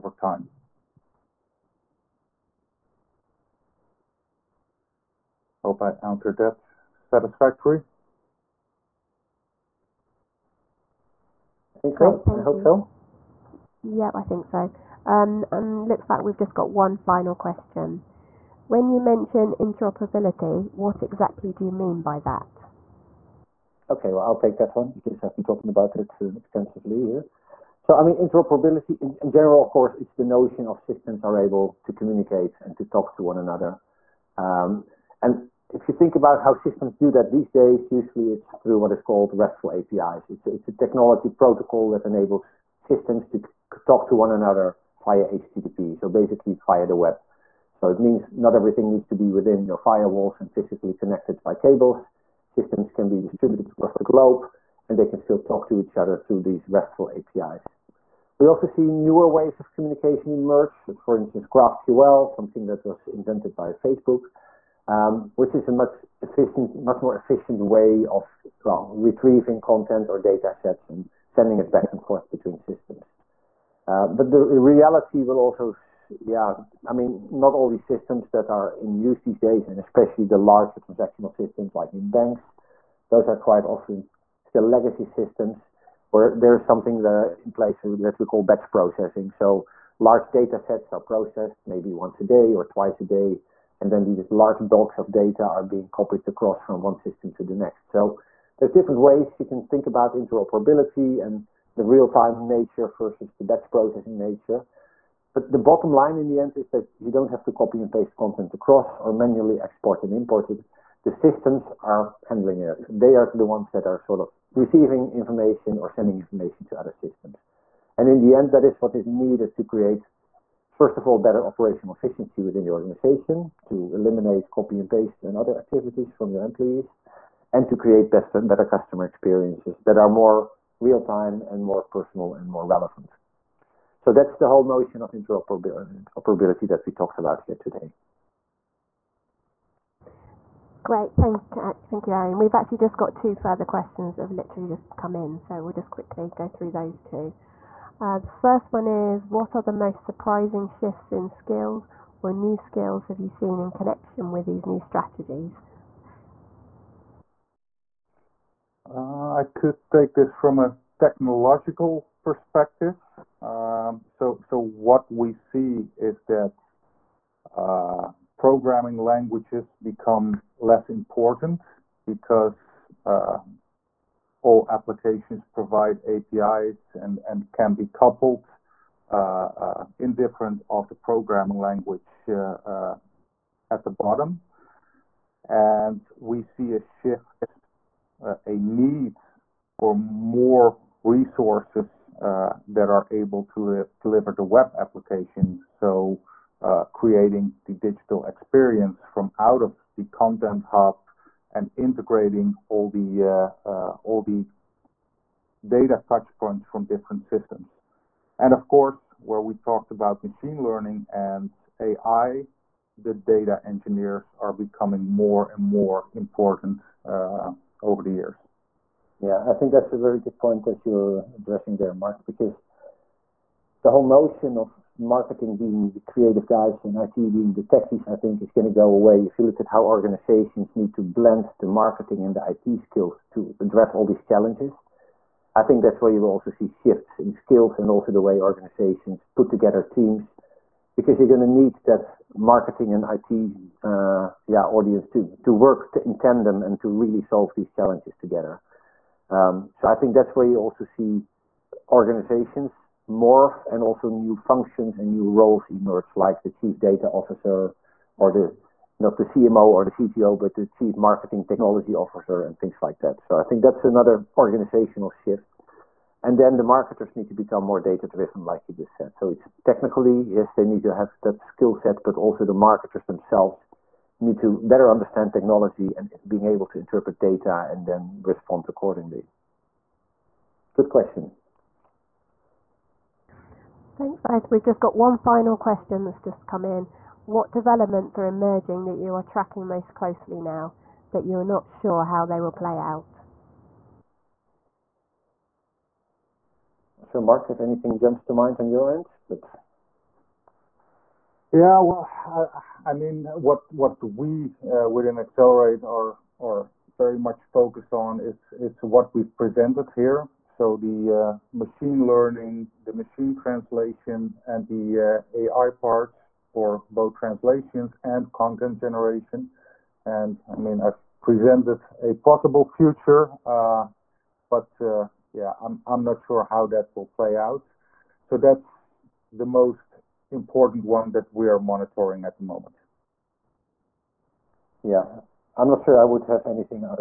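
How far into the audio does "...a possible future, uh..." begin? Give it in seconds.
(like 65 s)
322 s.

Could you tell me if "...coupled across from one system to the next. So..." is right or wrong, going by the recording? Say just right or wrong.
wrong.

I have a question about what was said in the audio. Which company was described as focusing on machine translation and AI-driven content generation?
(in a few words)
EXLRT.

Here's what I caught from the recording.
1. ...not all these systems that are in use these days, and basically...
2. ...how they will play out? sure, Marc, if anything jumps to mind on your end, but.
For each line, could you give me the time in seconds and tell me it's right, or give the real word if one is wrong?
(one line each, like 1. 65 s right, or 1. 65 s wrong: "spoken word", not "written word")
1. 77 s wrong: "especially", not "basically"
2. 292 s right.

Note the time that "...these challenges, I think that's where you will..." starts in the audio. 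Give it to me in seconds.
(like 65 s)
234 s.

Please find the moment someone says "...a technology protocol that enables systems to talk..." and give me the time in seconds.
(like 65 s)
40 s.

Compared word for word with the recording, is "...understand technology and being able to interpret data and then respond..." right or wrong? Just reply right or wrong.
right.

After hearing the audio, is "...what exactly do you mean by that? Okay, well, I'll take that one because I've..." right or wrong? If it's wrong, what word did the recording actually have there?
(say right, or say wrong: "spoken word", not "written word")
right.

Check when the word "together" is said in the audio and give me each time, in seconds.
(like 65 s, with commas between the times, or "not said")
239 s, 248 s.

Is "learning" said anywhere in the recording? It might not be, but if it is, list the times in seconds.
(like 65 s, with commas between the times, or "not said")
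210 s, 312 s.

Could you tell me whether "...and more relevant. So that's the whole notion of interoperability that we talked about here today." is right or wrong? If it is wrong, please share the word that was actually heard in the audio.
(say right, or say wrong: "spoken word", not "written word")
right.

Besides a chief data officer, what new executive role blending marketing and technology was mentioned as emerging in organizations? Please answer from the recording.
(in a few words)
chief marketing technology officer.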